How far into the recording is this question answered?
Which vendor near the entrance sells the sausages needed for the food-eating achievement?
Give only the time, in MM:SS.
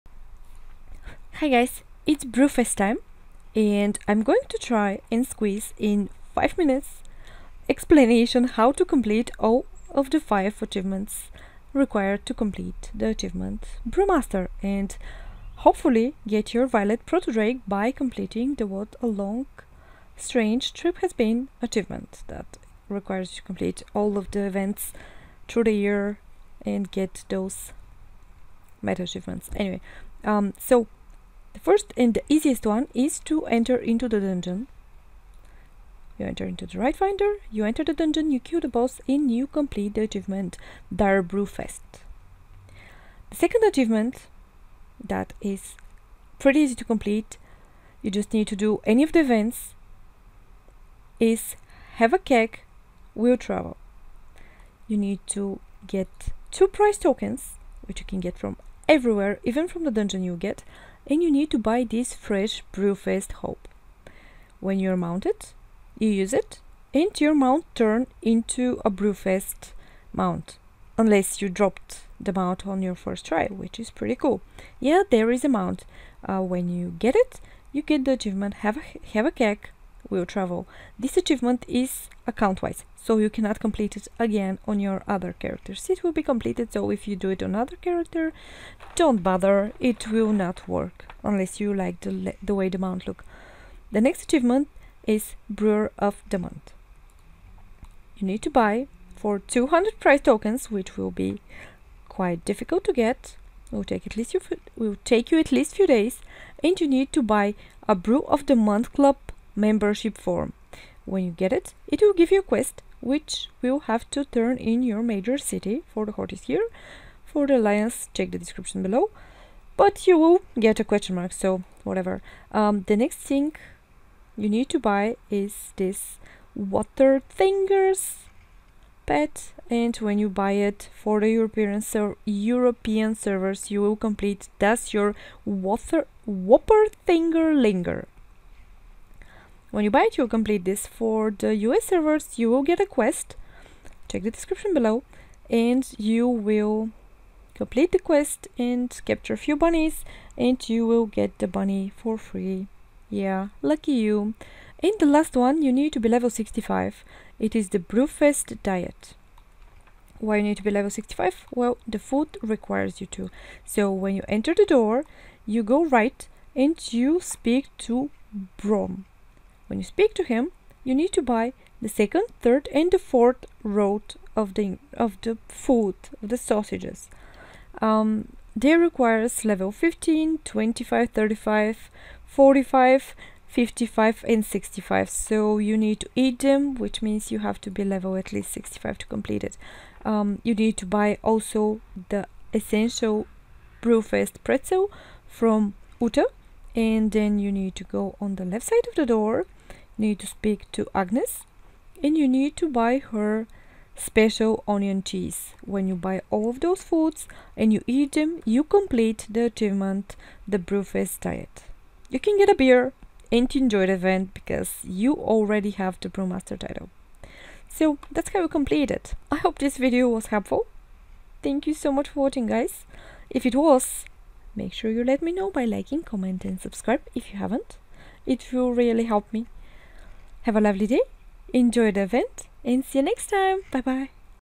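02:48.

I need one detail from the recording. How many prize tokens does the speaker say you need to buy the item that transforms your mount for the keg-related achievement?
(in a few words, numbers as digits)
2.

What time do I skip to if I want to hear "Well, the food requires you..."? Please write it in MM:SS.
02:41.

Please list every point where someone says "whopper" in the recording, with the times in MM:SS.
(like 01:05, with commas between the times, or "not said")
02:16.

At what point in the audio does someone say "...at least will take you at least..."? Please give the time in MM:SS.
01:44.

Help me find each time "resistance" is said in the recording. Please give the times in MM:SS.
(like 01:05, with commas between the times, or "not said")
not said.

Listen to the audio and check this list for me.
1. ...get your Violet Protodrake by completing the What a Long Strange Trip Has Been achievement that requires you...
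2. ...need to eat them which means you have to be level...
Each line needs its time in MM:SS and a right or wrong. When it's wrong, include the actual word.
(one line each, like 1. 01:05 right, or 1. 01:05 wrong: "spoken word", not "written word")
1. 00:16 right
2. 03:05 right.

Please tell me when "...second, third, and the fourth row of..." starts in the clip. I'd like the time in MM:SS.
02:51.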